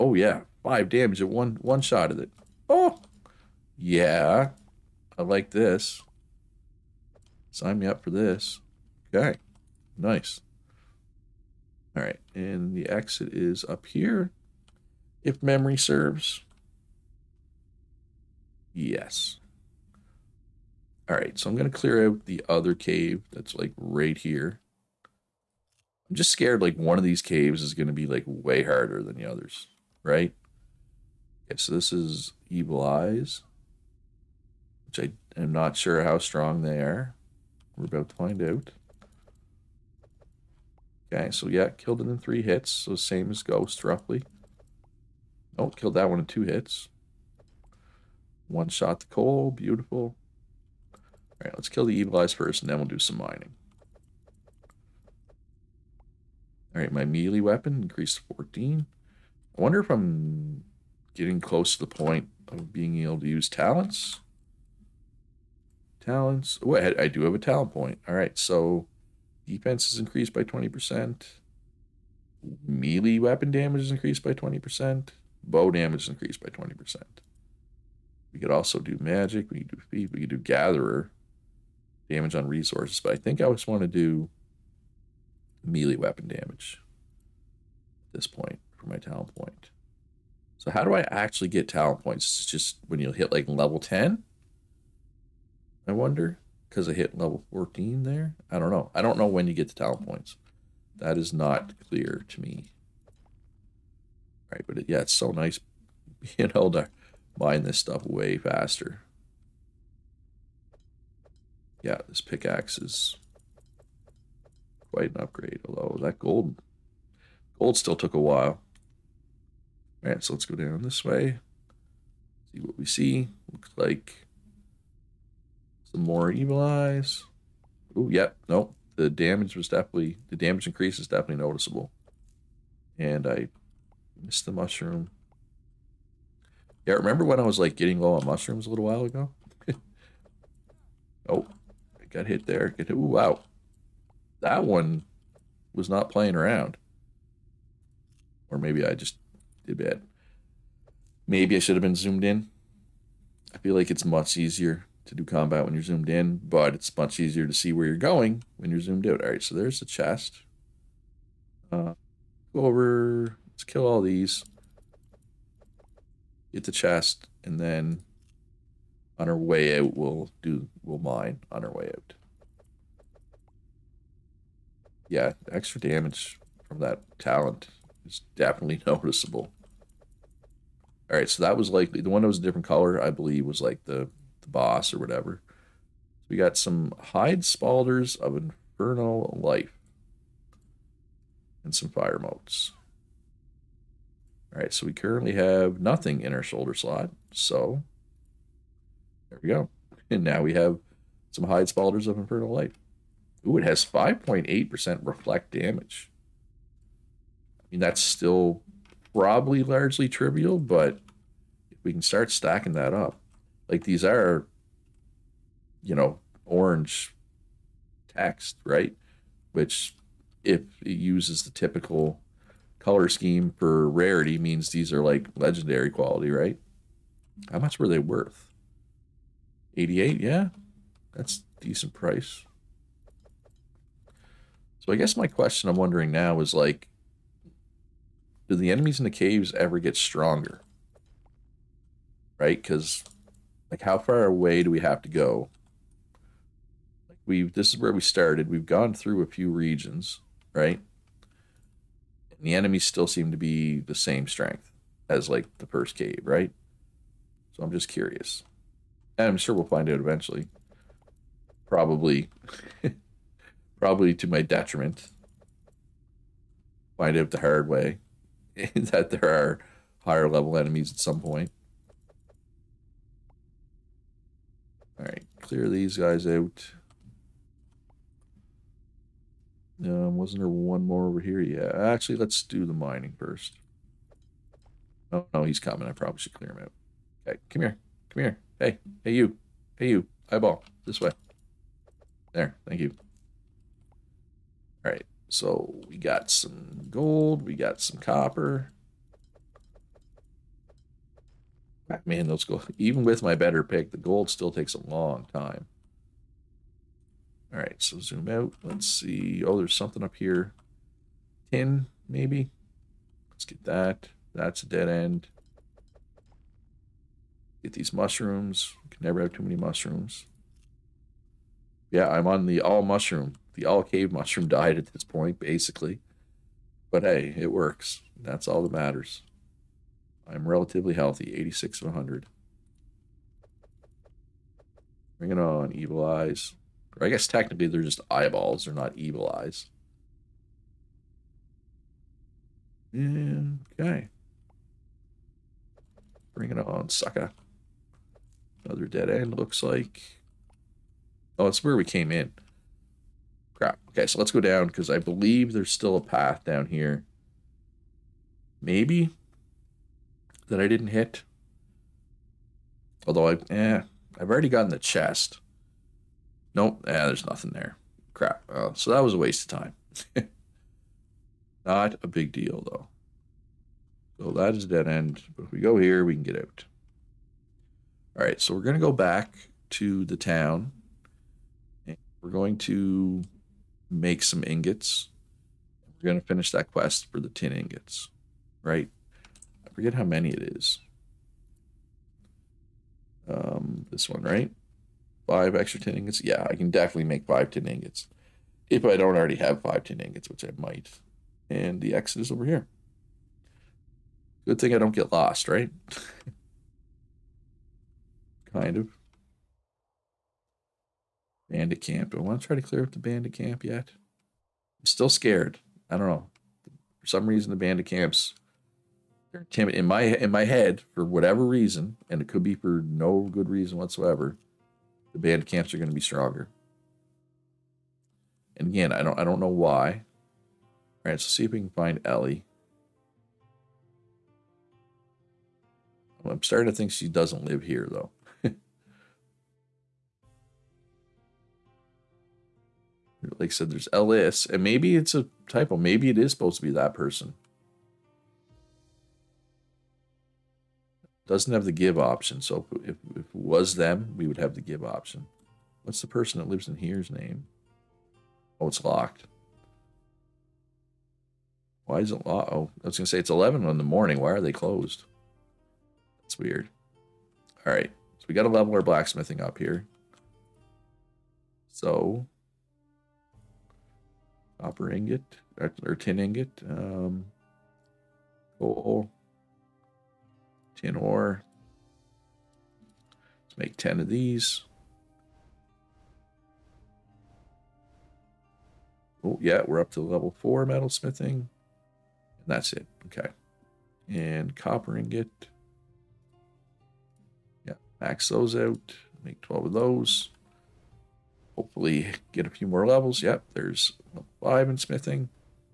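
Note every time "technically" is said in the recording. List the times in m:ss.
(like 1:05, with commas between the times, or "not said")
5:37.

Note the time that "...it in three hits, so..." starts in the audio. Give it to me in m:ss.
0:42.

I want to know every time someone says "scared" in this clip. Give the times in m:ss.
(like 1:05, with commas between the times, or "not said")
0:26, 6:55.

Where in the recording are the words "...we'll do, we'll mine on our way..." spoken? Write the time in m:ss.
2:49.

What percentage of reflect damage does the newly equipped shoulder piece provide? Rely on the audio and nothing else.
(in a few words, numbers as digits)
5.8%.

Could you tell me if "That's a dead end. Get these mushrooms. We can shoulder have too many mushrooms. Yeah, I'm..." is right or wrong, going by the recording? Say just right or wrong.
wrong.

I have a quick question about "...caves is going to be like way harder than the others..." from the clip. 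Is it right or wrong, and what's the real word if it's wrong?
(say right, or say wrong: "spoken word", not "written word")
right.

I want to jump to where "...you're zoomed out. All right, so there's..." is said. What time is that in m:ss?
2:38.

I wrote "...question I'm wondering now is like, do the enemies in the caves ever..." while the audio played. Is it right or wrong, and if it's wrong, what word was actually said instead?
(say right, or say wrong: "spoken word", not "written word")
right.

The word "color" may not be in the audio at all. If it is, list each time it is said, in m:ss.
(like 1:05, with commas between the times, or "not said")
3:02, 3:42.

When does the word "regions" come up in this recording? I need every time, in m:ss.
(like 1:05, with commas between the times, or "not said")
4:09.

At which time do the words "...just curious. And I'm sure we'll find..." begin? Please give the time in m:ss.
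4:17.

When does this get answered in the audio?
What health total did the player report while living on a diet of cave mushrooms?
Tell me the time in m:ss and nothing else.
5:31.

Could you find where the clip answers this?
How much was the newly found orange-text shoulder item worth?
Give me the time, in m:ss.
3:49.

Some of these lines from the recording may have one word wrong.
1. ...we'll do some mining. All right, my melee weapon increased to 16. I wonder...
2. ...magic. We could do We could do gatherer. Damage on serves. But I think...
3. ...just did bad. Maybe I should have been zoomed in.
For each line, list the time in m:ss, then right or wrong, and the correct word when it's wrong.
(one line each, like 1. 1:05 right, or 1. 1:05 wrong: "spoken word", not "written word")
1. 0:52 wrong: "14", not "16"
2. 1:19 wrong: "resources", not "serves"
3. 2:28 right.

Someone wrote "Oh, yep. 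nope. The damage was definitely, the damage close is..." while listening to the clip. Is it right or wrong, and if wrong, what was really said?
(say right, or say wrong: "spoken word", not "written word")
wrong: "increase", not "close".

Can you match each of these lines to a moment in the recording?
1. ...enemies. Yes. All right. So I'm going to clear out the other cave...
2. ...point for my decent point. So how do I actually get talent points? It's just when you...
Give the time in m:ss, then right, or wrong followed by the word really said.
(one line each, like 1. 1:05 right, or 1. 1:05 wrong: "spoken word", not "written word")
1. 0:15 wrong: "serves", not "enemies"
2. 1:28 wrong: "talent", not "decent".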